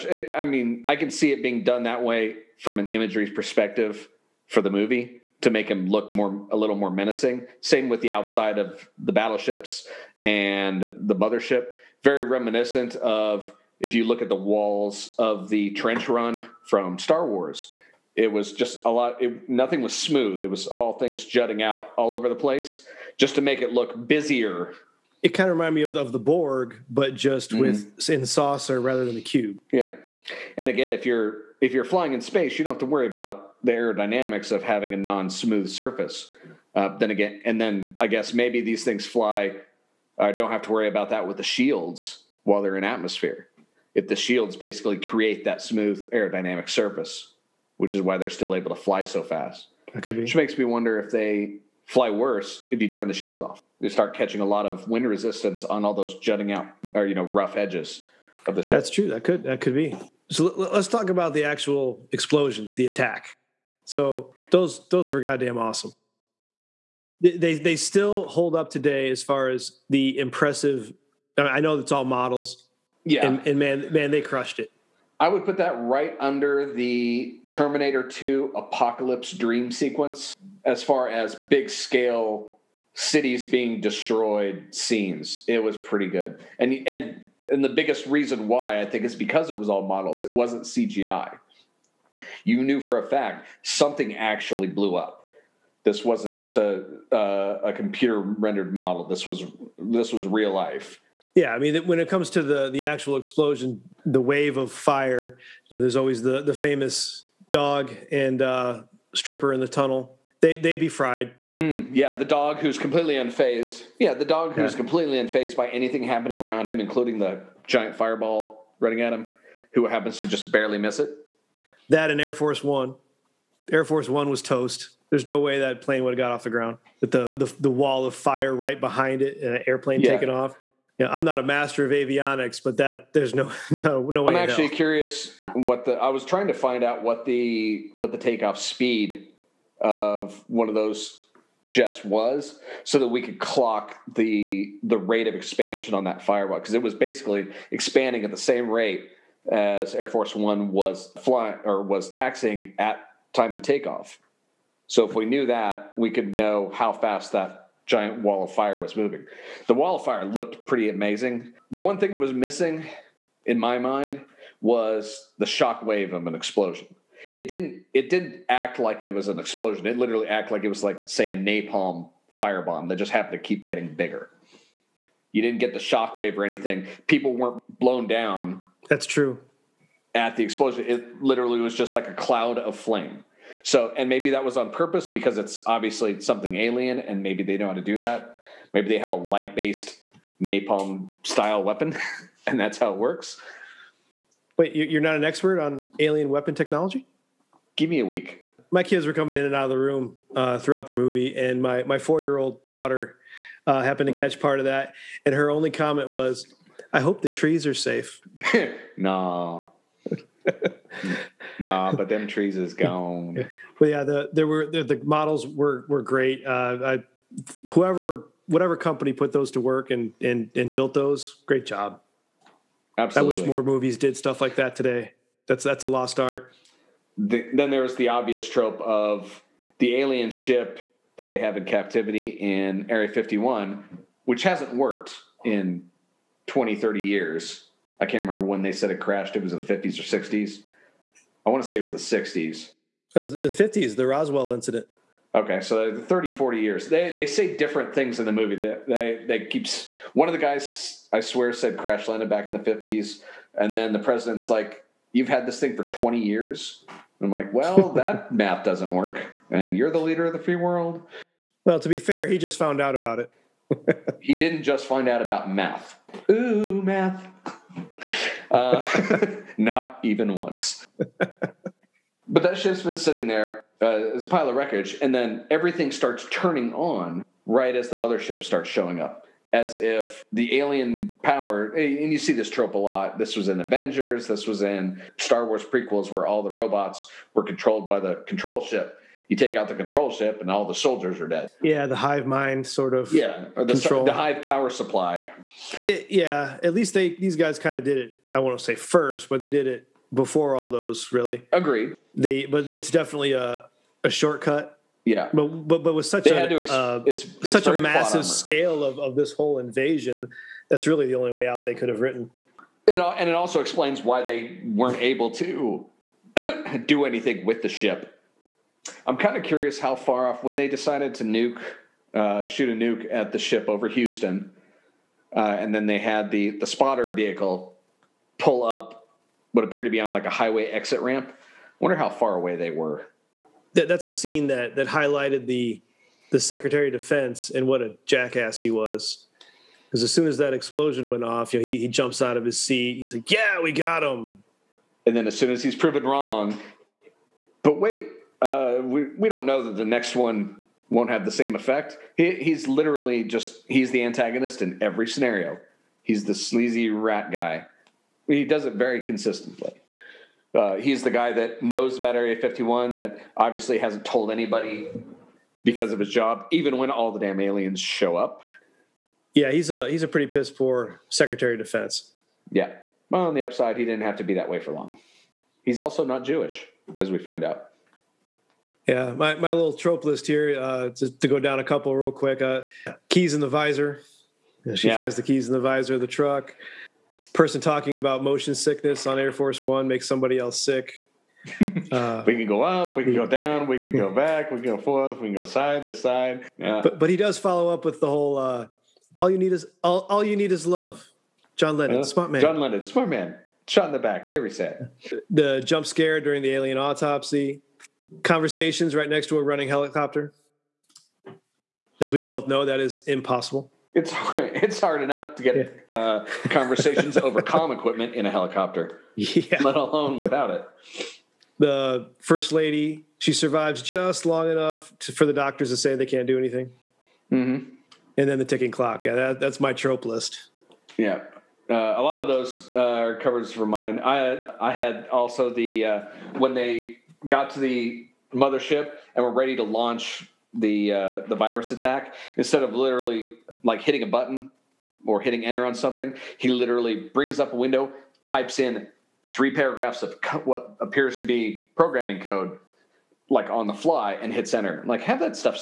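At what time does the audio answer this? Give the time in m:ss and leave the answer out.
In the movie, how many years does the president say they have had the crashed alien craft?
4:15.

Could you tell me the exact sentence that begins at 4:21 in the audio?
Well, to be fair, he just found out about it.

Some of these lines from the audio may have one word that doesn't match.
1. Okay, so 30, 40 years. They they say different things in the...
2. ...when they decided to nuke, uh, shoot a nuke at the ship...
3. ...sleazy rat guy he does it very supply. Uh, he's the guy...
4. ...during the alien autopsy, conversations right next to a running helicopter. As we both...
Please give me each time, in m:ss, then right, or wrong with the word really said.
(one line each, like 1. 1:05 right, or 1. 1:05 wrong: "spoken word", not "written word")
1. 4:05 right
2. 5:20 right
3. 5:56 wrong: "consistently", not "supply"
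4. 6:46 right.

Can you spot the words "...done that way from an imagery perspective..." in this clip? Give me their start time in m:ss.
0:01.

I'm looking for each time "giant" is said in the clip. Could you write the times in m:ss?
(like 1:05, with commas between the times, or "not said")
1:57, 2:37.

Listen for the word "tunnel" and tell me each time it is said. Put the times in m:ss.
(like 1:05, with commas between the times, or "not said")
1:49.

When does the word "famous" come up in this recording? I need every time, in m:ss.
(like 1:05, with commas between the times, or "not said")
1:46.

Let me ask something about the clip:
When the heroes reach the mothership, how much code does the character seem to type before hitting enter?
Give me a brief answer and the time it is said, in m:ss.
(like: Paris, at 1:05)
three paragraphs, at 7:29.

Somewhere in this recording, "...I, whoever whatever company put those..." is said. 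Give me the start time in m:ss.
3:36.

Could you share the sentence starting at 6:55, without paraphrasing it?
uh, conversations over comm equipment in a helicopter, yeah.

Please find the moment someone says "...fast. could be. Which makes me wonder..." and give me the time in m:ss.
0:49.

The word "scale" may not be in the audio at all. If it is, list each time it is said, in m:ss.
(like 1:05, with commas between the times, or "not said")
1:21, 5:08.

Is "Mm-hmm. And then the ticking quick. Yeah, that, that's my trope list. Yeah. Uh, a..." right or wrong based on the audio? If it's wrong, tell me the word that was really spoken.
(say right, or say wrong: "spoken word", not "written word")
wrong: "clock", not "quick".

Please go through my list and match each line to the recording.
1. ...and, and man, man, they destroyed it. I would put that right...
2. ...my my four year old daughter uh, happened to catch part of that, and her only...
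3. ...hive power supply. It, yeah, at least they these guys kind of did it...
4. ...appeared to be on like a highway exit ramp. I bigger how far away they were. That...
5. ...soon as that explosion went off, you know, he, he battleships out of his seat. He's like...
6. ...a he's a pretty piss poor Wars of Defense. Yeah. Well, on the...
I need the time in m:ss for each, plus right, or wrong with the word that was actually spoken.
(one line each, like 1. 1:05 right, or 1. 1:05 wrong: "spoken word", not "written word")
1. 1:13 wrong: "crushed", not "destroyed"
2. 3:21 right
3. 4:54 right
4. 5:29 wrong: "wonder", not "bigger"
5. 5:40 wrong: "jumps", not "battleships"
6. 6:09 wrong: "Secretary", not "Wars".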